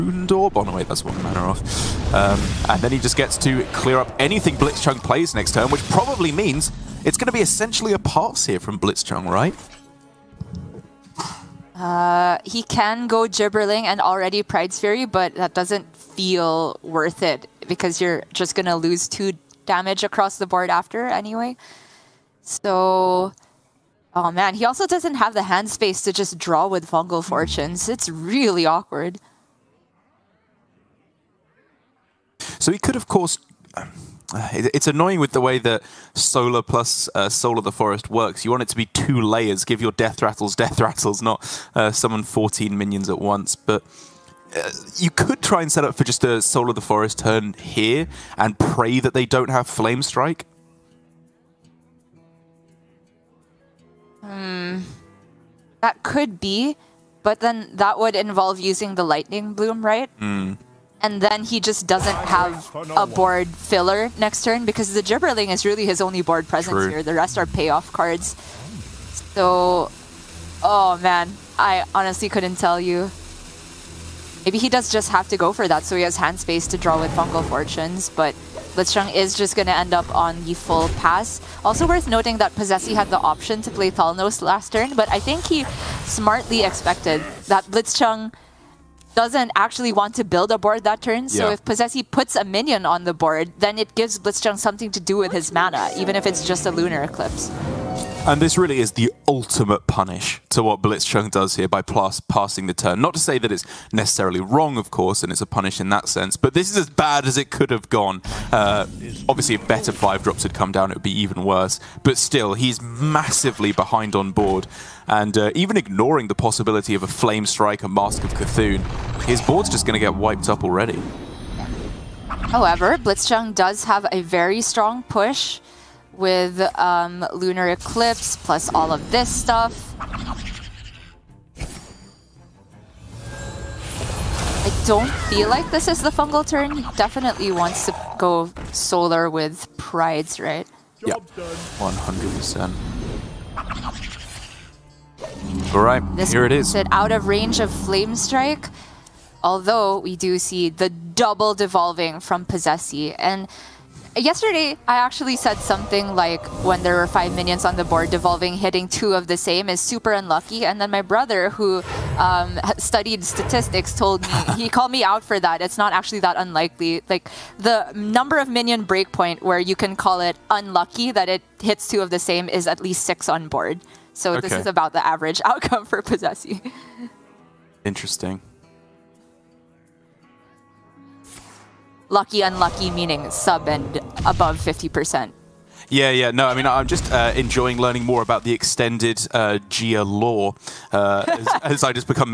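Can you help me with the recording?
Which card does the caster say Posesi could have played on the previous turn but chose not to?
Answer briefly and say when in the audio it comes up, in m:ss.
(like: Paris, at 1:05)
Thalnos, at 1:23.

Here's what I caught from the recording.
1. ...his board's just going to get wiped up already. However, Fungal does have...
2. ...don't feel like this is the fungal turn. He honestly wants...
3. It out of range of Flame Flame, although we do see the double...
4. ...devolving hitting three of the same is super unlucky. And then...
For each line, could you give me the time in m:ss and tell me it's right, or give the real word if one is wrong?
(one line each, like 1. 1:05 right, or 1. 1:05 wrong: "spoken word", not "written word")
1. 1:59 wrong: "Blitzchung", not "Fungal"
2. 2:14 wrong: "definitely", not "honestly"
3. 2:26 wrong: "Strike", not "Flame"
4. 2:38 wrong: "two", not "three".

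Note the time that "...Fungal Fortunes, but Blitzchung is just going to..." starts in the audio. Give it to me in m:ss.
1:17.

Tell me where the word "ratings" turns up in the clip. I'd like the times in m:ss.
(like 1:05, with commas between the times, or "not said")
not said.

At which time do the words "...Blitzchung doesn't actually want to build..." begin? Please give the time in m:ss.
1:27.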